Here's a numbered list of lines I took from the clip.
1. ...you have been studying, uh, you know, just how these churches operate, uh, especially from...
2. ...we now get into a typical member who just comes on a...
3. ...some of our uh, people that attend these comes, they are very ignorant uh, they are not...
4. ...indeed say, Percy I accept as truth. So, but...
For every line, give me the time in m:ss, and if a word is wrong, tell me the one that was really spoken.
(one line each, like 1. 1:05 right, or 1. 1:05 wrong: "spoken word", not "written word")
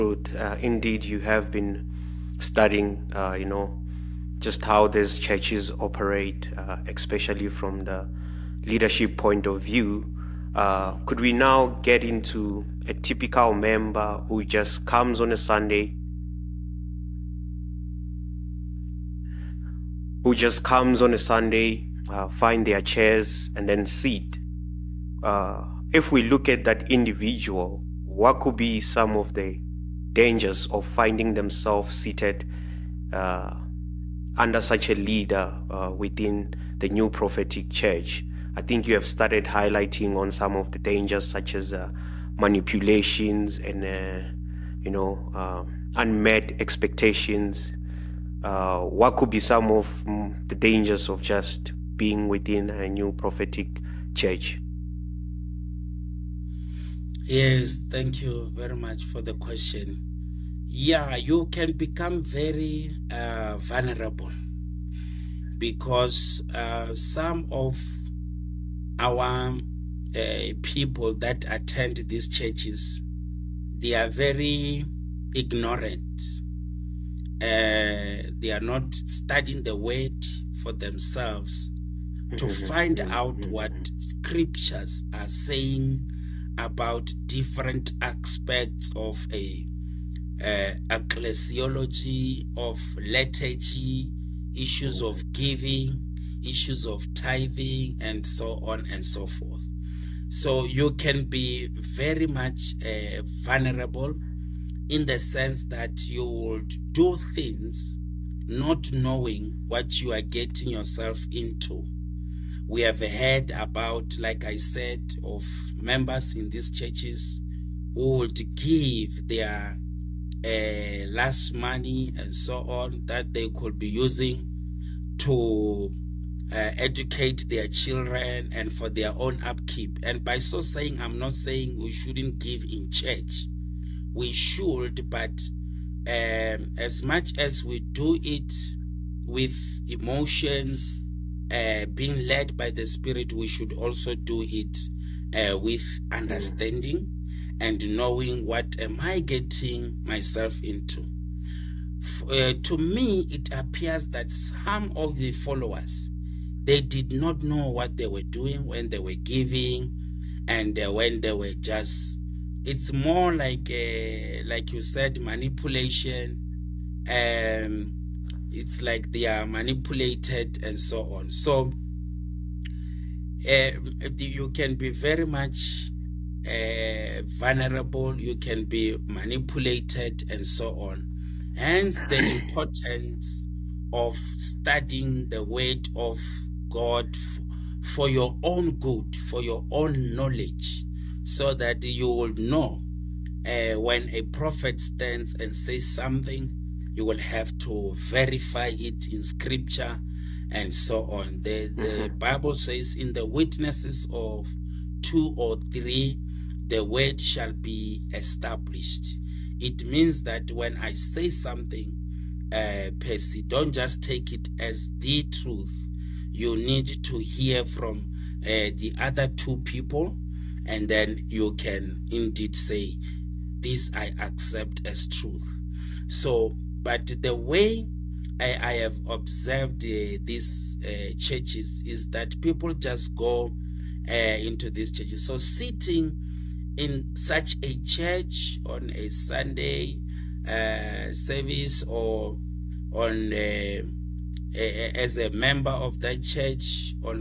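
1. 0:01 right
2. 0:11 right
3. 1:06 wrong: "churches", not "comes"
4. 3:42 wrong: "This", not "Percy".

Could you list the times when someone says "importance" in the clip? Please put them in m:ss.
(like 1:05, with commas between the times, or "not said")
3:02.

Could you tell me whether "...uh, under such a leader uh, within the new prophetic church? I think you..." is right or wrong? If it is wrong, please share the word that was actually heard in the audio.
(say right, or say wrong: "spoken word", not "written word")
right.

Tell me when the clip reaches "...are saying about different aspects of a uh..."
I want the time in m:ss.
1:25.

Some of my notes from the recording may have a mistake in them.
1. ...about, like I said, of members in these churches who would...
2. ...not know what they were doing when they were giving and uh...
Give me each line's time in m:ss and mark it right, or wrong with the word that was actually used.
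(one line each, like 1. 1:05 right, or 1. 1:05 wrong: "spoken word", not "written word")
1. 1:53 right
2. 2:37 right.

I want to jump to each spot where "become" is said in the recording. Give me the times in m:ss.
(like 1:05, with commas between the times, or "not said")
1:01.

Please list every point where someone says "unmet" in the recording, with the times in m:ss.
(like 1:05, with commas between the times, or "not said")
0:45.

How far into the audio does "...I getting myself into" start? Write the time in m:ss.
2:29.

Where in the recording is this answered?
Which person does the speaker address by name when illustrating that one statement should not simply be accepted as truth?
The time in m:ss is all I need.
3:32.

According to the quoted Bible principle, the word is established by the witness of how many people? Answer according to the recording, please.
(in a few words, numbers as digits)
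2 or 3.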